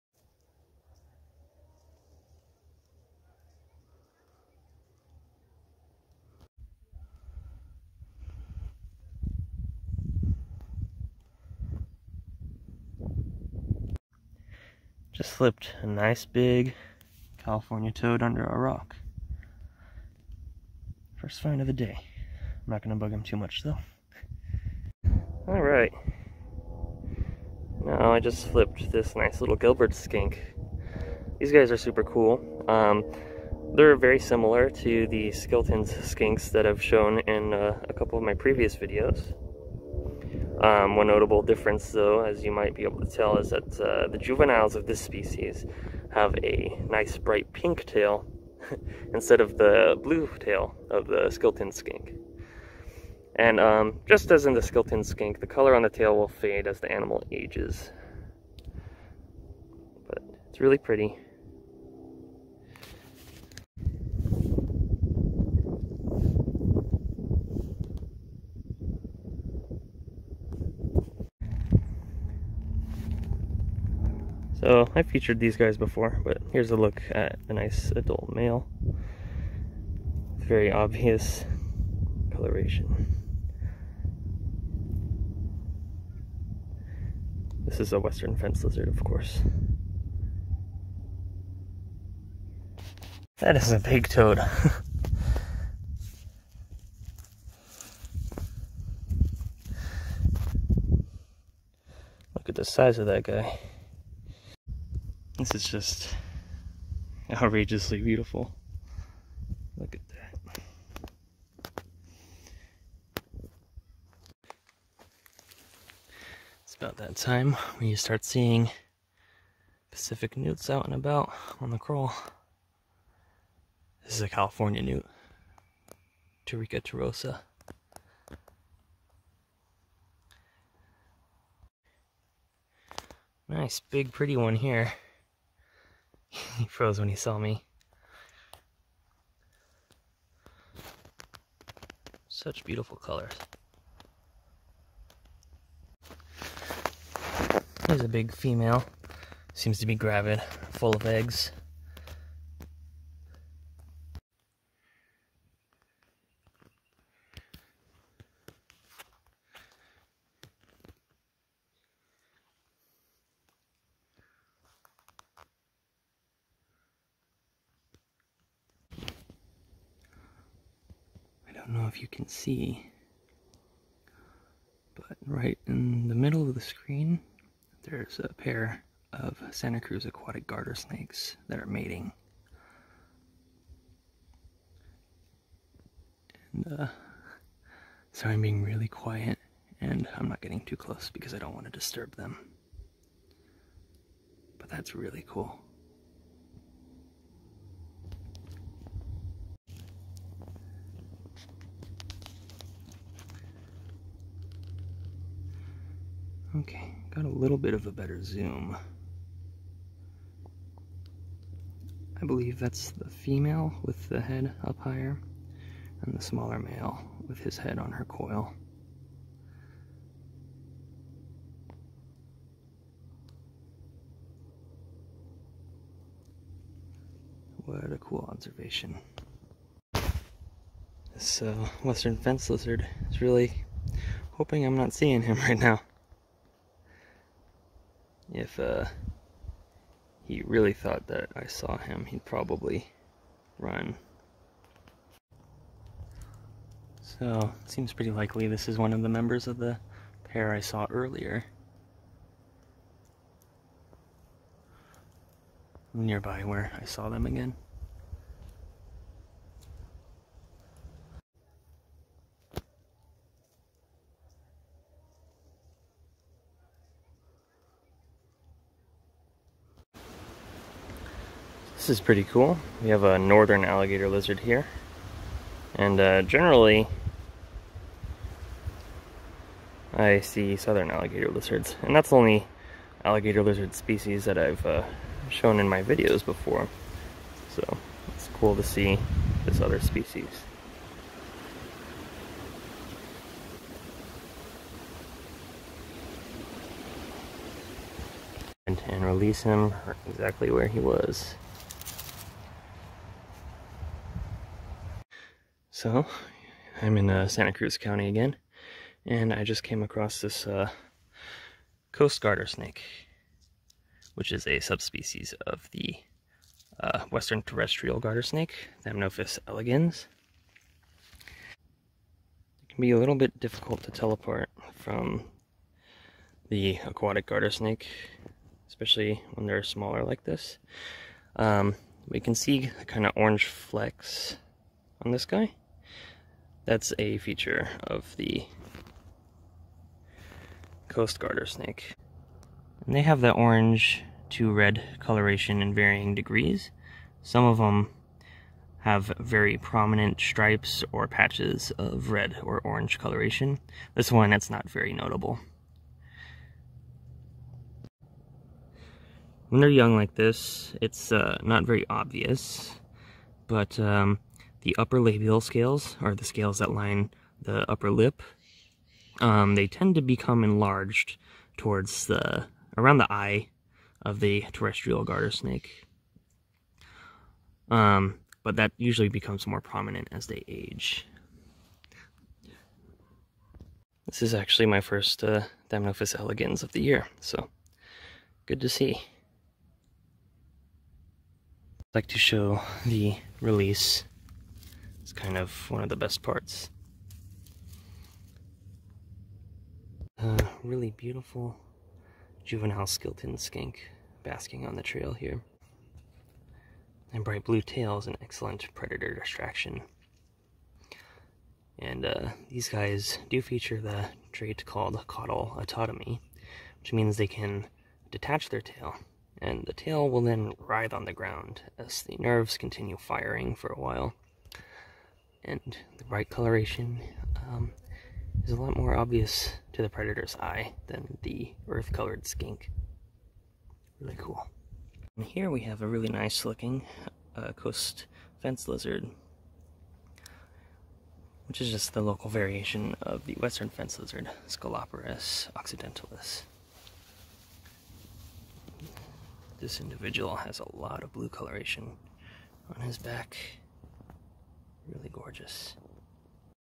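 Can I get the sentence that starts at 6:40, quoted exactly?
Uh, really beautiful juvenile Skilton skink basking on the trail here.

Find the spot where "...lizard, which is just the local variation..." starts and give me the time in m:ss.
7:18.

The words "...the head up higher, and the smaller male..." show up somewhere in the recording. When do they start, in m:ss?
3:34.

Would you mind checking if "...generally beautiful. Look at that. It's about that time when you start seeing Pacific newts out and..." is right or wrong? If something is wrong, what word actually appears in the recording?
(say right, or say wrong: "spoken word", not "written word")
wrong: "outrageously", not "generally".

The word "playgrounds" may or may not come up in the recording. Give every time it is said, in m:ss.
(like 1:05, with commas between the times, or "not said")
not said.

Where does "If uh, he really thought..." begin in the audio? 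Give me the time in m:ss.
3:58.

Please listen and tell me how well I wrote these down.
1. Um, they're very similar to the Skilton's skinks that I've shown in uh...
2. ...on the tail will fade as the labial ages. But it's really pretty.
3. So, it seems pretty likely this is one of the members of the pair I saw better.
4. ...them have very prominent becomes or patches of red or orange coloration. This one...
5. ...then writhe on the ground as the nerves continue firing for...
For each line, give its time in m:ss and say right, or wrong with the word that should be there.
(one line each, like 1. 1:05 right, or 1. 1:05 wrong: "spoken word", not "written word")
1. 0:32 right
2. 0:55 wrong: "animal", not "labial"
3. 4:07 wrong: "earlier", not "better"
4. 5:47 wrong: "stripes", not "becomes"
5. 7:00 right.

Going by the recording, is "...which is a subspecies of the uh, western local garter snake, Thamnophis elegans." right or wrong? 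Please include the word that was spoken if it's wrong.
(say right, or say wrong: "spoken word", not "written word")
wrong: "terrestrial", not "local".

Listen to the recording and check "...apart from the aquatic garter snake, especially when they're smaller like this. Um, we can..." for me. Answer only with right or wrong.
right.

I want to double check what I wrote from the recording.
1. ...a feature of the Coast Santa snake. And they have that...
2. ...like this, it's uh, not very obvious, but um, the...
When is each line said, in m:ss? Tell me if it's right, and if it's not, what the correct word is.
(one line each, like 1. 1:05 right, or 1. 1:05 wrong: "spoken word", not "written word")
1. 5:36 wrong: "Garter", not "Santa"
2. 5:59 right.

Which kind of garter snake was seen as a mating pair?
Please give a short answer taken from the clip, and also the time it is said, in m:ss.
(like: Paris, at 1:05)
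Santa Cruz aquatic garter snakes, at 2:59.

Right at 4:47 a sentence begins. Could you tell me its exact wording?
So it's cool to see this other species.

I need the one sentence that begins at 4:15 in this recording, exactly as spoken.
Nearby where I saw them again.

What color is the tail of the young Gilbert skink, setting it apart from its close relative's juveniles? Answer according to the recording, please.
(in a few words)
bright pink.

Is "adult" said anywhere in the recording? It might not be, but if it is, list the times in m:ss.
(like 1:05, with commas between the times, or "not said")
1:17.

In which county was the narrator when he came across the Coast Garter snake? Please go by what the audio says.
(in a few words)
Santa Cruz County.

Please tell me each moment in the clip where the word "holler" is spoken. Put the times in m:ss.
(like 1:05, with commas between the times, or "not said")
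not said.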